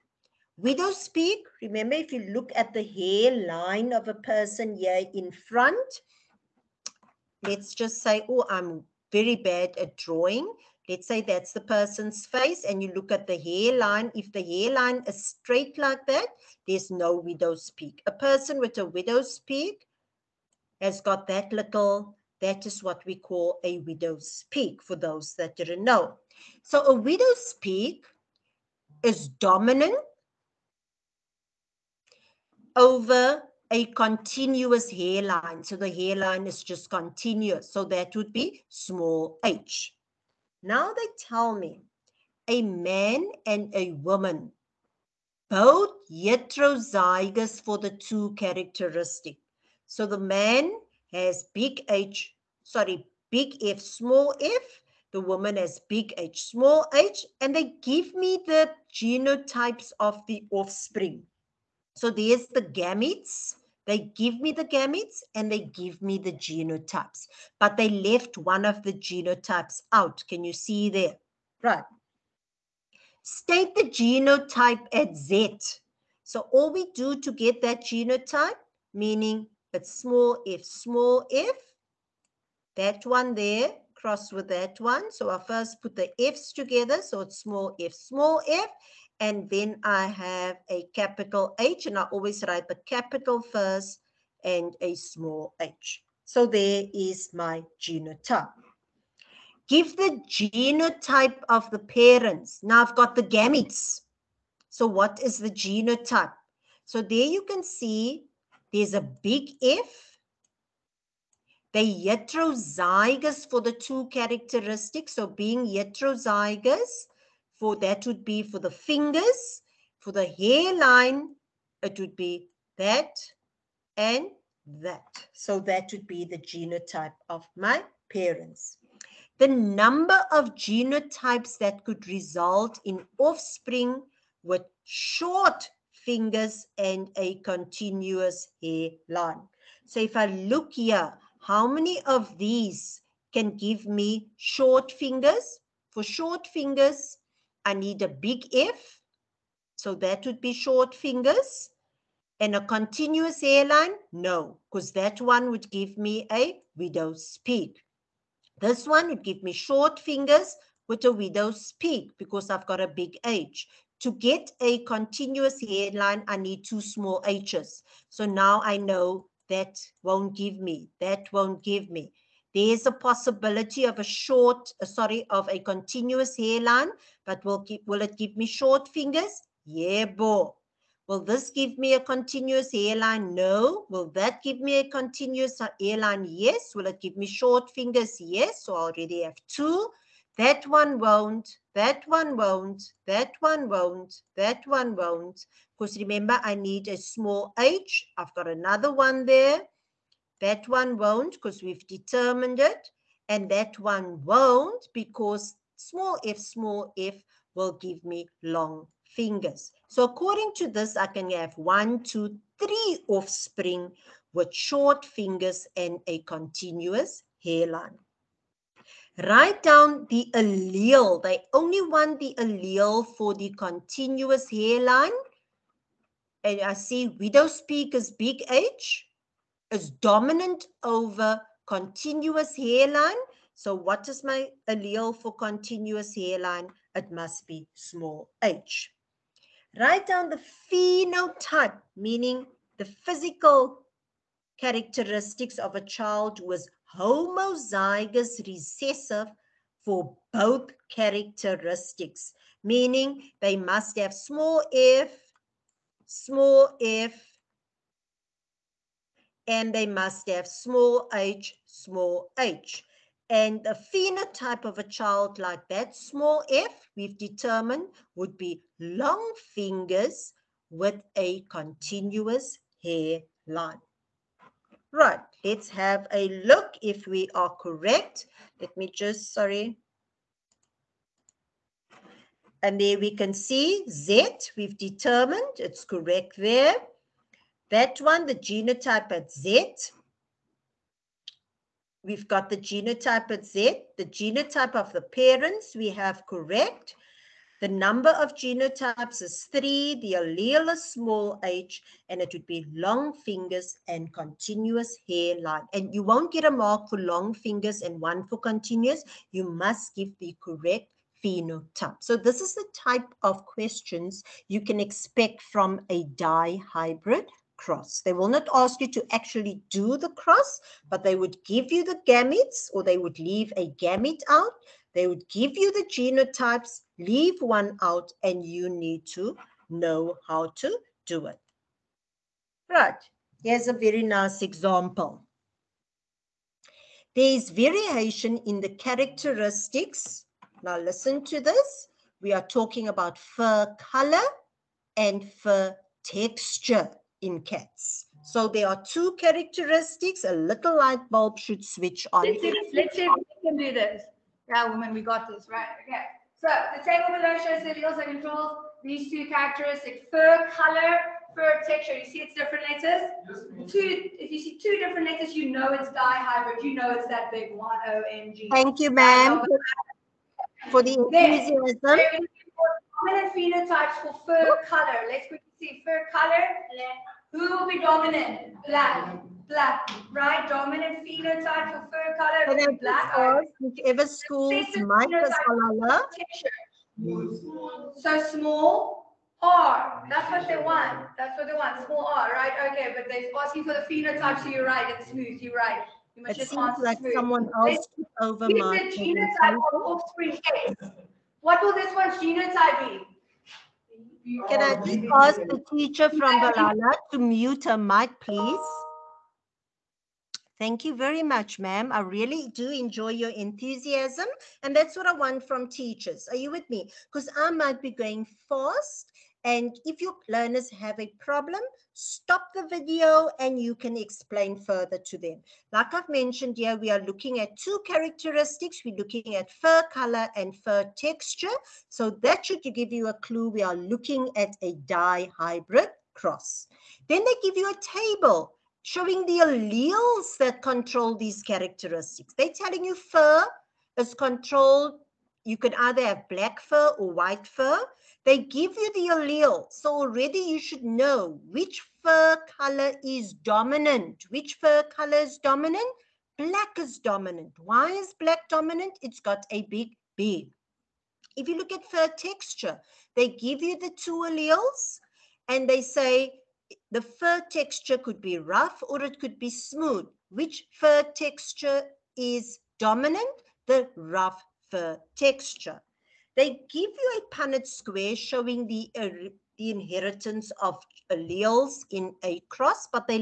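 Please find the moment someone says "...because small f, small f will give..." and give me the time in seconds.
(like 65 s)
204 s.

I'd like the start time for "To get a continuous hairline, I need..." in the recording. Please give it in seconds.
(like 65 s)
164 s.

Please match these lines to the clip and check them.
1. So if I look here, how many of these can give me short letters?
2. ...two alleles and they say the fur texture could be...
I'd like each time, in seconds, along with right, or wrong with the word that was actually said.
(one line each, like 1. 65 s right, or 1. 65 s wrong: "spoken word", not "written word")
1. 139 s wrong: "fingers", not "letters"
2. 464 s right.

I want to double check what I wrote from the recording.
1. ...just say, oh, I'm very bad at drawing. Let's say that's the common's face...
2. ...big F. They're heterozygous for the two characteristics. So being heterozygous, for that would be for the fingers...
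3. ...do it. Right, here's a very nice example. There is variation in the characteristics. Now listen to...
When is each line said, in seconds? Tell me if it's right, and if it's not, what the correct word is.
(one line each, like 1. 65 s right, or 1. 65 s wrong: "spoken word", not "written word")
1. 7 s wrong: "person", not "common"
2. 109 s right
3. 331 s right.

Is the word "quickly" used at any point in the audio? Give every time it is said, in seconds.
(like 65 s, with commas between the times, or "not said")
375 s.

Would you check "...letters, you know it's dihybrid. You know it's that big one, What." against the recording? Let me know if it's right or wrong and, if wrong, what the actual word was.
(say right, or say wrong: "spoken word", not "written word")
wrong: "OMG", not "What".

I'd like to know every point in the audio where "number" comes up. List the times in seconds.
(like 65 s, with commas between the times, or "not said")
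129 s, 297 s.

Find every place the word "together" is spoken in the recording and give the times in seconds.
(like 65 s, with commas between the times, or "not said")
86 s.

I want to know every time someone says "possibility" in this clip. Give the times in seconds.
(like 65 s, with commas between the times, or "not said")
172 s.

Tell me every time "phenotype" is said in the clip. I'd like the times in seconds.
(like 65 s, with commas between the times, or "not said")
240 s, 263 s, 311 s, 373 s, 381 s, 393 s.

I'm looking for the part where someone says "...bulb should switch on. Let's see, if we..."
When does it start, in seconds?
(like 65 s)
351 s.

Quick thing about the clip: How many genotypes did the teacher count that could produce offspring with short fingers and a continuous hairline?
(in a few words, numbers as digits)
3.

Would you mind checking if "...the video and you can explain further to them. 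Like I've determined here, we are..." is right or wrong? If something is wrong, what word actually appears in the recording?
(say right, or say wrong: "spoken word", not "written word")
wrong: "mentioned", not "determined".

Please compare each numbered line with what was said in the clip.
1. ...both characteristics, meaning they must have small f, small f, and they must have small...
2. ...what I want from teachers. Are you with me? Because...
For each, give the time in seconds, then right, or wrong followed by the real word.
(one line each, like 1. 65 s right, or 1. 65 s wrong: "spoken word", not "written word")
1. 250 s right
2. 414 s right.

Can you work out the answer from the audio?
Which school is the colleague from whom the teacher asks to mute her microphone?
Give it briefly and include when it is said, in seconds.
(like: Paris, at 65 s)
Balala, at 406 s.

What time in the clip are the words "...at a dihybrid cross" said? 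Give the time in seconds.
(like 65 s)
434 s.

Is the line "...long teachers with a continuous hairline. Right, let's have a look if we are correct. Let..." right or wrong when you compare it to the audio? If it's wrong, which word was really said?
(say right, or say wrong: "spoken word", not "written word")
wrong: "fingers", not "teachers".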